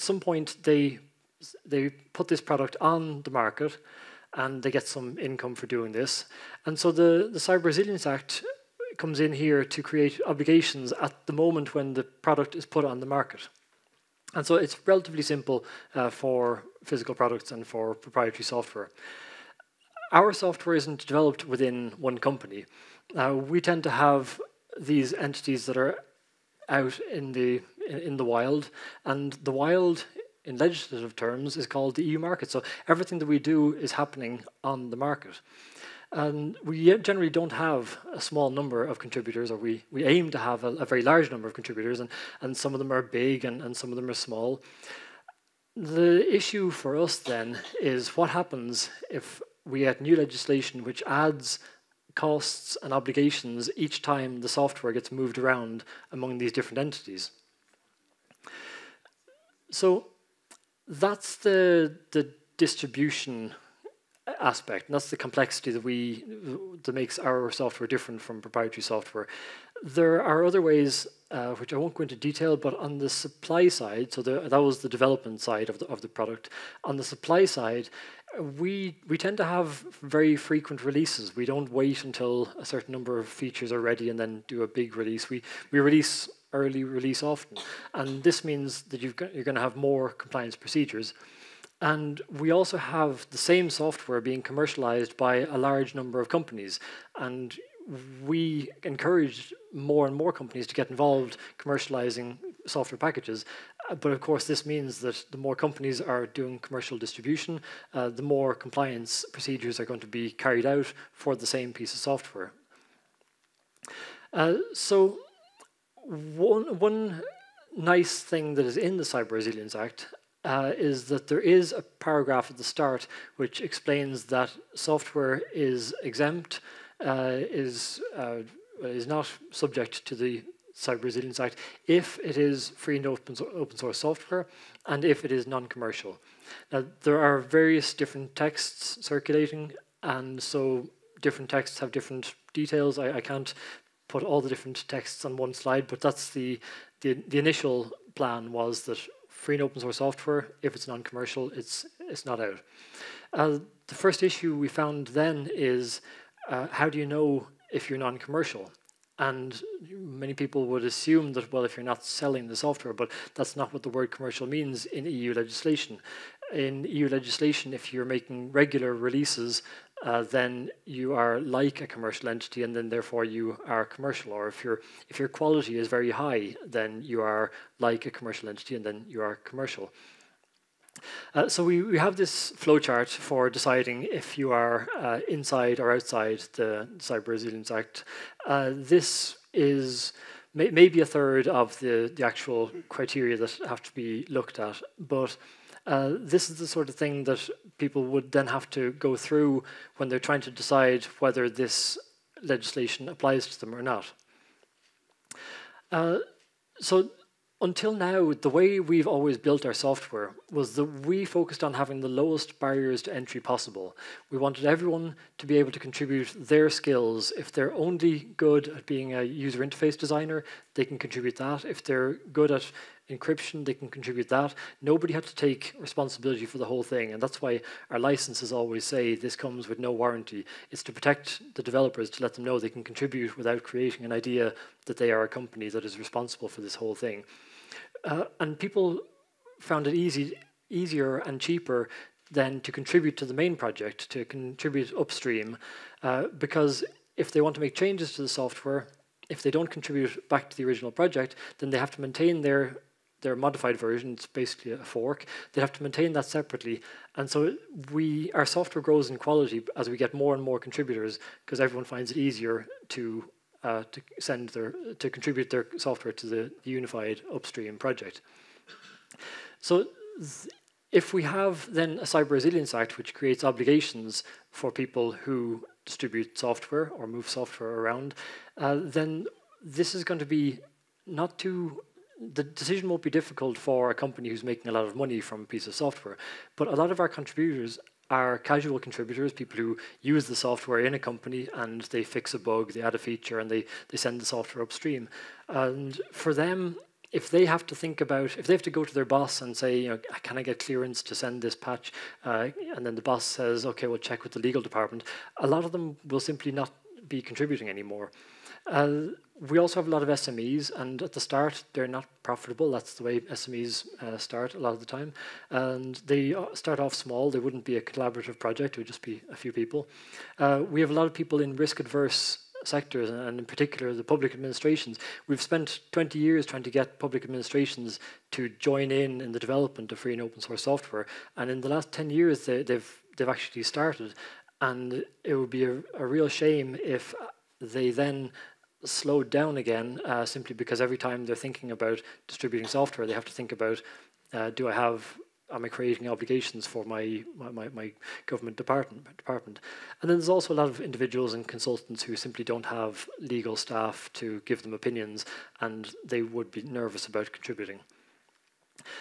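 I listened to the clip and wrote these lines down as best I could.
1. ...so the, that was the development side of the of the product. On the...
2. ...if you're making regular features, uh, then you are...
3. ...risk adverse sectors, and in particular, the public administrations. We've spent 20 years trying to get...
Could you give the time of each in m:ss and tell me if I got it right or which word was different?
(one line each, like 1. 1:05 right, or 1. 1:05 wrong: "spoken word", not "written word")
1. 1:14 right
2. 2:47 wrong: "releases", not "features"
3. 5:21 right.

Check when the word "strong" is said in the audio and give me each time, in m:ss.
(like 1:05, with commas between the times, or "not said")
not said.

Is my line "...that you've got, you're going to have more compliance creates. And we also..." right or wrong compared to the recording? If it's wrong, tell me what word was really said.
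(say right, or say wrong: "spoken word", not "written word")
wrong: "procedures", not "creates".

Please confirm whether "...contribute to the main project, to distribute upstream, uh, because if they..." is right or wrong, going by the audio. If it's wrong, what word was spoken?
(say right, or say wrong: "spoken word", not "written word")
wrong: "contribute", not "distribute".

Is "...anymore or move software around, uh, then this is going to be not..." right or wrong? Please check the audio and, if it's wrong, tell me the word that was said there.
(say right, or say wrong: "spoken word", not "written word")
wrong: "software", not "anymore".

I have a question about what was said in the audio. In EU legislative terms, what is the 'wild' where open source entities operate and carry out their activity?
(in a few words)
the EU market.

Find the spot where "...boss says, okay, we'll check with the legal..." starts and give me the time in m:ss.
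5:03.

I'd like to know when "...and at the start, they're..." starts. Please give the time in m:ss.
5:10.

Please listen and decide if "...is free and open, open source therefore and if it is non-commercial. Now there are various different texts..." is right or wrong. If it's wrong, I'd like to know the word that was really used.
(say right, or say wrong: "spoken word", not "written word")
wrong: "software", not "therefore".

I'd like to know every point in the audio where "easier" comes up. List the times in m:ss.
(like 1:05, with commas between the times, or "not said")
4:00, 4:22.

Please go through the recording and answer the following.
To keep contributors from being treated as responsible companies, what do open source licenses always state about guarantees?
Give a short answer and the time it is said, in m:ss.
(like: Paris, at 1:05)
no warranty, at 3:49.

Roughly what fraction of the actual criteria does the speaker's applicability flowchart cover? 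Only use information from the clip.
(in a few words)
a third.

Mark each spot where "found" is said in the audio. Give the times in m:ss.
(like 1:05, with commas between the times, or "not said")
2:34, 3:59.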